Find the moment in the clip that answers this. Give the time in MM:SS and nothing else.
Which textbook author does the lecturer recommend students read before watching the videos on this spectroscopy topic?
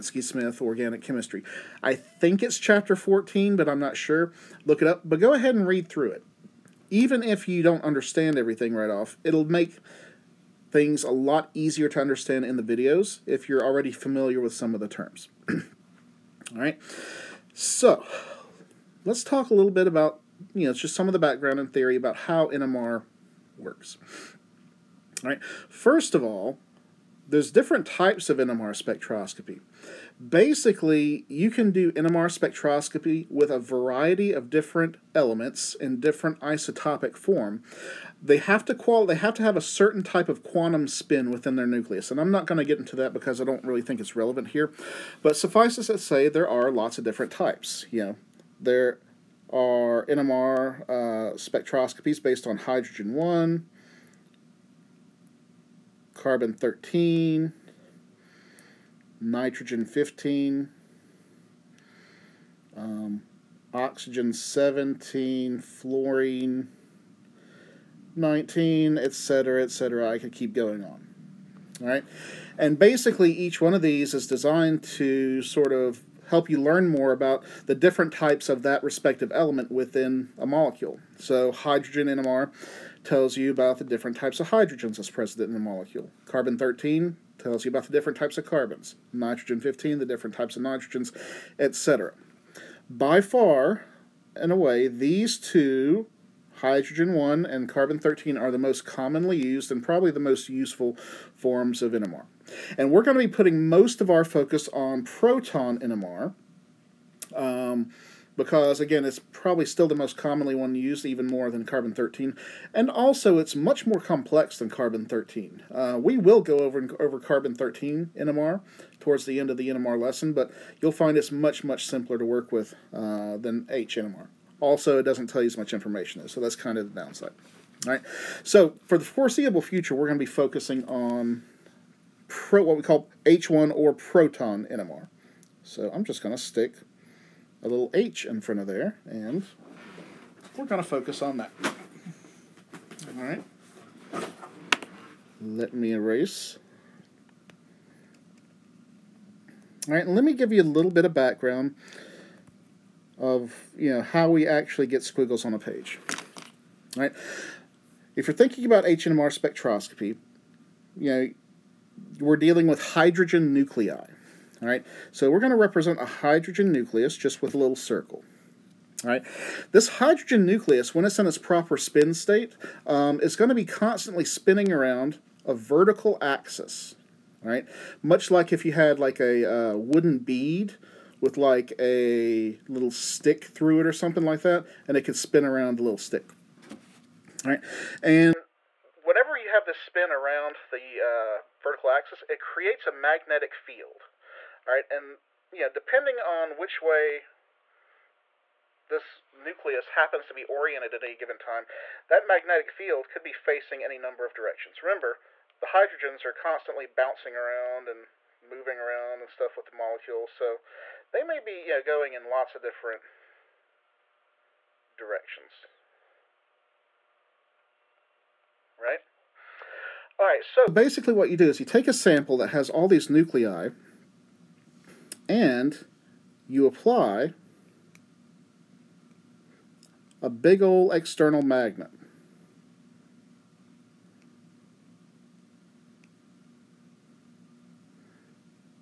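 00:00.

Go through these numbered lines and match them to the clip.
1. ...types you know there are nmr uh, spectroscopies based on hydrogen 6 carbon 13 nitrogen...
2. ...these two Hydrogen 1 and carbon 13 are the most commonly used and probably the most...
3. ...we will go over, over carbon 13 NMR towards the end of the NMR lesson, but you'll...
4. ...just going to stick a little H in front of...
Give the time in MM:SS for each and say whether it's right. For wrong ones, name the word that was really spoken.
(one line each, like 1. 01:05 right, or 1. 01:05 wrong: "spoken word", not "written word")
1. 00:47 wrong: "1", not "6"
2. 01:34 right
3. 01:56 right
4. 02:16 right.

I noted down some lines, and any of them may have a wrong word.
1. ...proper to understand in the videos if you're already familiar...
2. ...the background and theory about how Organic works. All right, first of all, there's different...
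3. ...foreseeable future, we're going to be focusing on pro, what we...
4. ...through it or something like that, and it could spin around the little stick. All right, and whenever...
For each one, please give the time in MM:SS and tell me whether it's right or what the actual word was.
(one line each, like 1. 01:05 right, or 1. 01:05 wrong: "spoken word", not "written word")
1. 00:11 wrong: "easier", not "proper"
2. 00:21 wrong: "NMR", not "Organic"
3. 02:09 right
4. 03:03 right.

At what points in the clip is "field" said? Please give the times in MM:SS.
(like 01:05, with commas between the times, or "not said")
03:13, 03:22.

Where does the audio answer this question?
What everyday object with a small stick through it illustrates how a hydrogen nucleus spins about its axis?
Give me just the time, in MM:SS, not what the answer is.
02:59.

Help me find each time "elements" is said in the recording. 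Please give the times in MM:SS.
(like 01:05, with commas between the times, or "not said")
00:35, 01:19.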